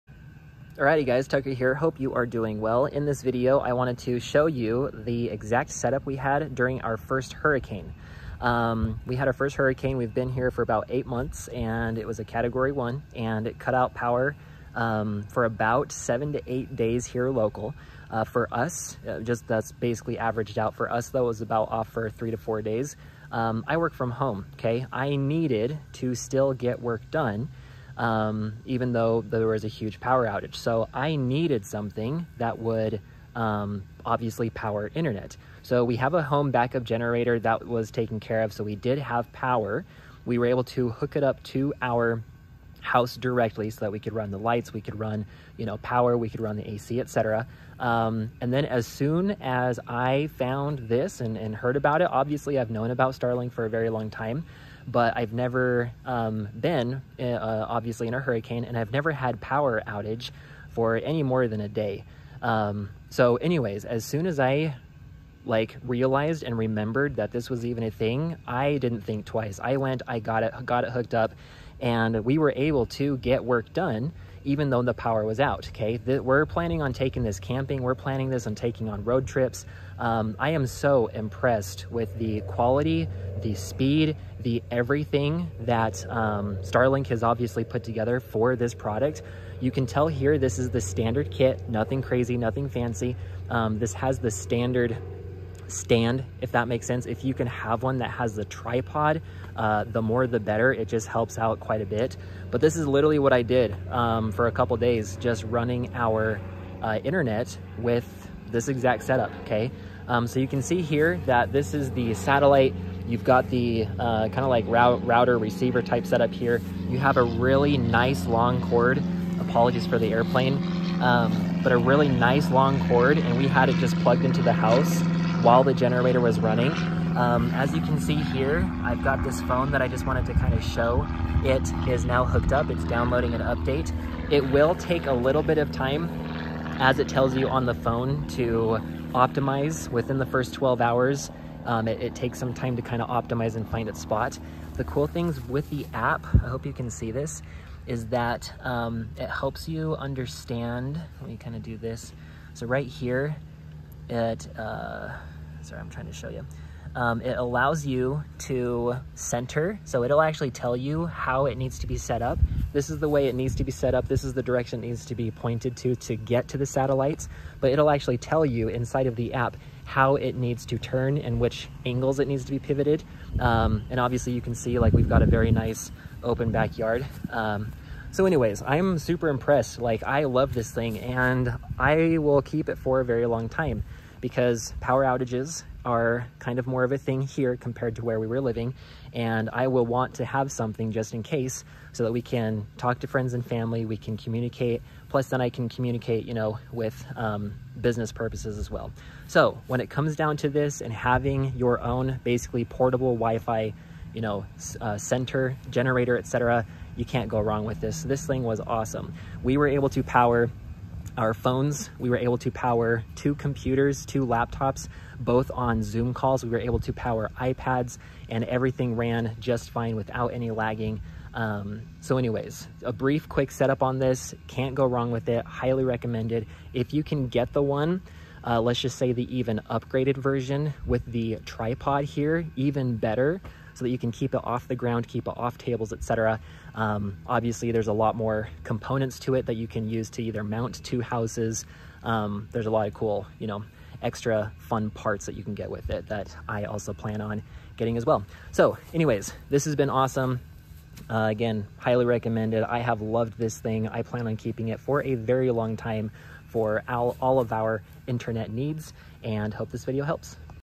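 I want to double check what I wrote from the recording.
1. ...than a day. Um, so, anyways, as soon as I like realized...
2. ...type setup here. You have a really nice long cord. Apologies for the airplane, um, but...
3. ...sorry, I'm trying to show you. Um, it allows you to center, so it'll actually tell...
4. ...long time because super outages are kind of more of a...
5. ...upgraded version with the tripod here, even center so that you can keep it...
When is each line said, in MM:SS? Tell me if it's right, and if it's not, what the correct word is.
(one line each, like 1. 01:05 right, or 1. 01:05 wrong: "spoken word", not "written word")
1. 01:01 right
2. 01:55 right
3. 02:35 right
4. 03:03 wrong: "power", not "super"
5. 03:49 wrong: "better", not "center".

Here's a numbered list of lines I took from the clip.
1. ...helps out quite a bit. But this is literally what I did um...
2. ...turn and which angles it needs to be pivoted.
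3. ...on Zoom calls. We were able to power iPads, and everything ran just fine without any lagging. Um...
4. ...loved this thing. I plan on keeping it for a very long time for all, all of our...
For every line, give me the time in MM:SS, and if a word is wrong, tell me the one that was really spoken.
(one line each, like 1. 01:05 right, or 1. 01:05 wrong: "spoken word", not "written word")
1. 01:41 right
2. 02:50 right
3. 03:35 right
4. 04:13 right.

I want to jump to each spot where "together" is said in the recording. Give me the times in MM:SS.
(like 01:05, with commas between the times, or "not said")
01:27.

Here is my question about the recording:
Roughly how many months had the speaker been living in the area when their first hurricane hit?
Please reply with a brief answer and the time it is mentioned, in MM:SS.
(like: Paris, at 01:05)
8, at 00:10.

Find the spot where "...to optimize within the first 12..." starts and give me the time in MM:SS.
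02:18.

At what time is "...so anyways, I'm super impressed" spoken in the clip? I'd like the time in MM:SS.
02:58.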